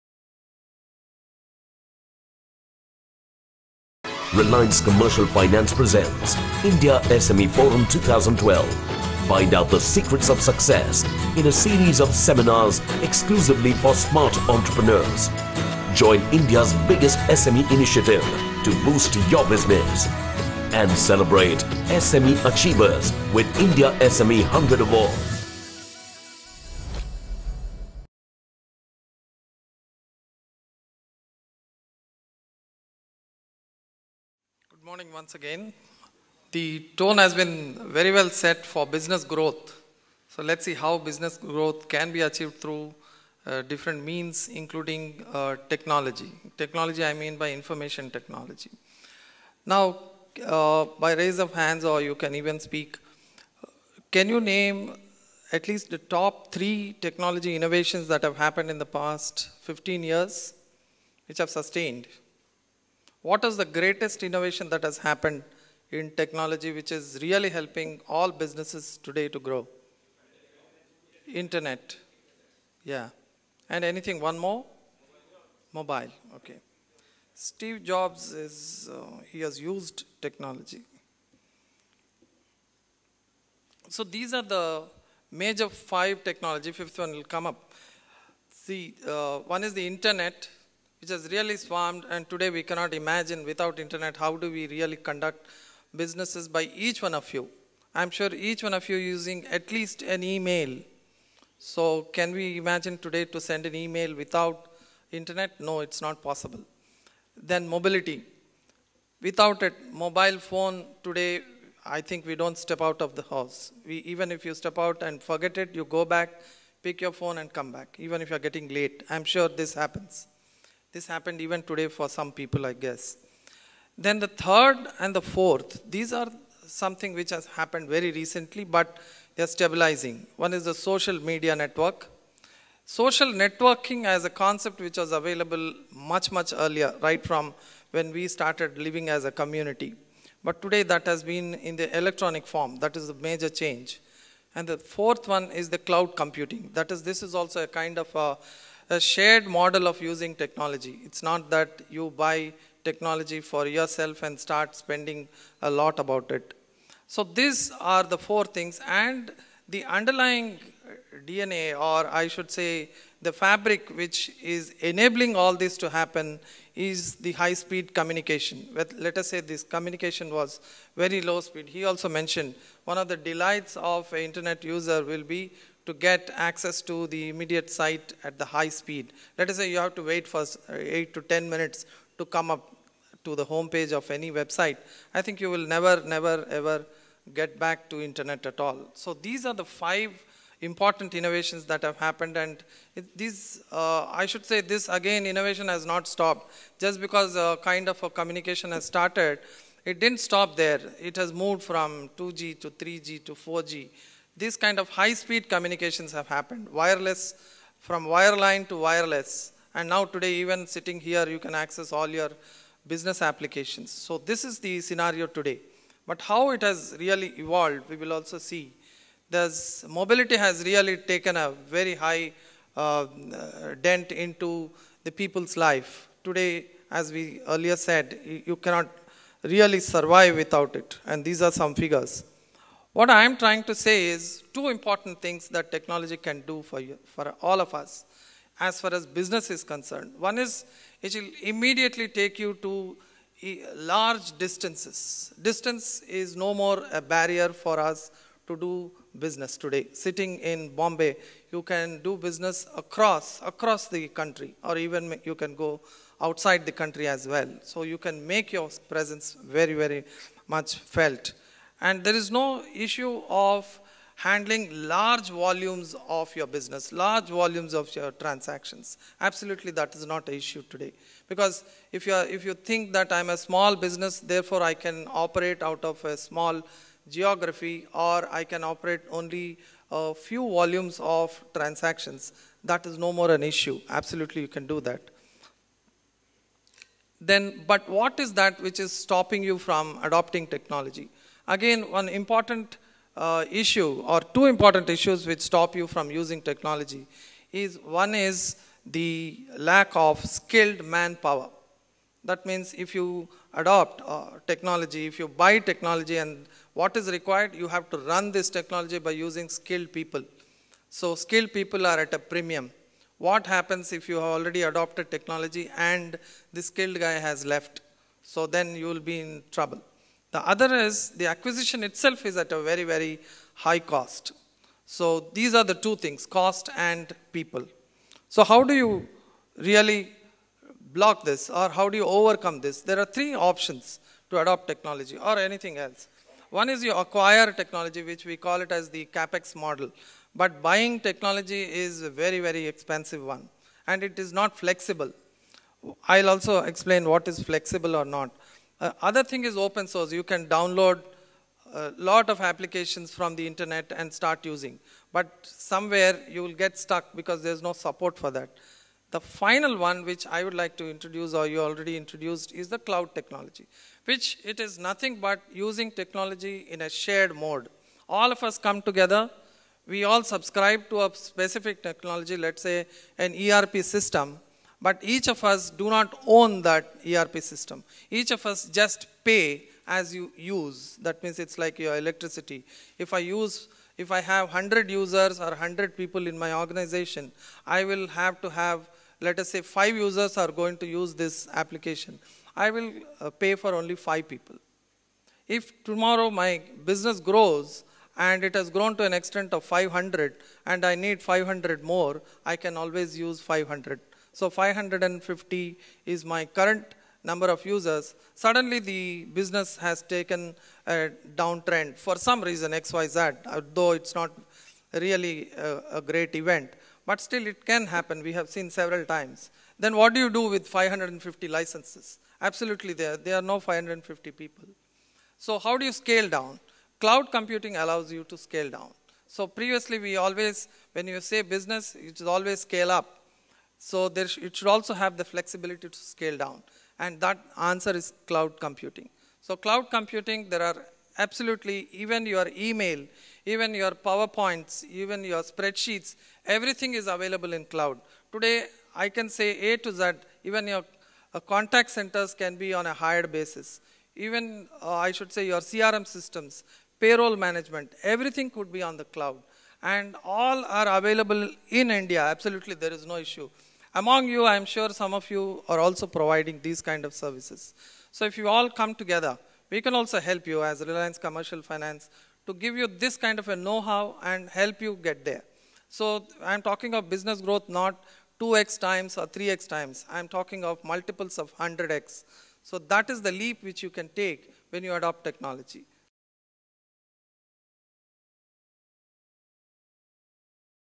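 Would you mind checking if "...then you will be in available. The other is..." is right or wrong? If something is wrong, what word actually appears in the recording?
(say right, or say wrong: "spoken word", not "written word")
wrong: "trouble", not "available".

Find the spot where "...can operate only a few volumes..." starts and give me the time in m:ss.
4:38.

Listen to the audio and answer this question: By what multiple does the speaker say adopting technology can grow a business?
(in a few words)
100x.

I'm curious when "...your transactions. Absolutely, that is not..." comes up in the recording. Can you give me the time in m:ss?
4:27.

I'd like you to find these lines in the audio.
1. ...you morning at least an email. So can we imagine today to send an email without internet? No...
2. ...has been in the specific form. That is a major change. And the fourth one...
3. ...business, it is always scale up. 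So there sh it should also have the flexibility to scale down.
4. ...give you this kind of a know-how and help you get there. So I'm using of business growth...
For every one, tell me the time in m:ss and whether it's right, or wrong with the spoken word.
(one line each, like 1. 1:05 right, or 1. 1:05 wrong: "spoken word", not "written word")
1. 1:38 wrong: "using", not "morning"
2. 2:21 wrong: "electronic", not "specific"
3. 7:11 right
4. 7:52 wrong: "talking", not "using".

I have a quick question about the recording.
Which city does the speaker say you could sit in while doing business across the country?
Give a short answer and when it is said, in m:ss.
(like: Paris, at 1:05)
Bombay, at 4:10.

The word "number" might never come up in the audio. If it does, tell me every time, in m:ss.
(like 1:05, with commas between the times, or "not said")
6:47.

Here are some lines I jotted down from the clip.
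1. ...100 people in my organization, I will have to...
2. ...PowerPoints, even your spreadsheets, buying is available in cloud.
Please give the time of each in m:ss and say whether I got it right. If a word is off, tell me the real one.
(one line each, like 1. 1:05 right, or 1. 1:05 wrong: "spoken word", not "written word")
1. 6:25 right
2. 7:24 wrong: "everything", not "buying".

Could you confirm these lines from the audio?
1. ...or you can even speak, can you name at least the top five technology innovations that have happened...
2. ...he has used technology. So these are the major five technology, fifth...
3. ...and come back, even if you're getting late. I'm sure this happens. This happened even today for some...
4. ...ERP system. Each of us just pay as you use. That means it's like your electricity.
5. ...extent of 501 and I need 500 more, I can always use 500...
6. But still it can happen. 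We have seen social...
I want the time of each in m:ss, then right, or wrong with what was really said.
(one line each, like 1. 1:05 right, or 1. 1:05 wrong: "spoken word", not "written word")
1. 0:51 wrong: "three", not "five"
2. 1:19 right
3. 1:57 right
4. 6:17 right
5. 6:39 wrong: "500", not "501"
6. 6:57 wrong: "several", not "social".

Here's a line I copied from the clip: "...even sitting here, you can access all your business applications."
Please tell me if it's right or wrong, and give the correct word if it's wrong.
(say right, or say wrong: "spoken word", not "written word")
right.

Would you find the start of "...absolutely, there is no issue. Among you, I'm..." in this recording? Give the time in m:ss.
7:42.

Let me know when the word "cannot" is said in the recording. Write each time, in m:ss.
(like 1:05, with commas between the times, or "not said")
1:32, 3:48.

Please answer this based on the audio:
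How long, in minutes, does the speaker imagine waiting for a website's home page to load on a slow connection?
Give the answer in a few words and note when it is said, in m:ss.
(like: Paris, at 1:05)
8 to 10 minutes, at 3:00.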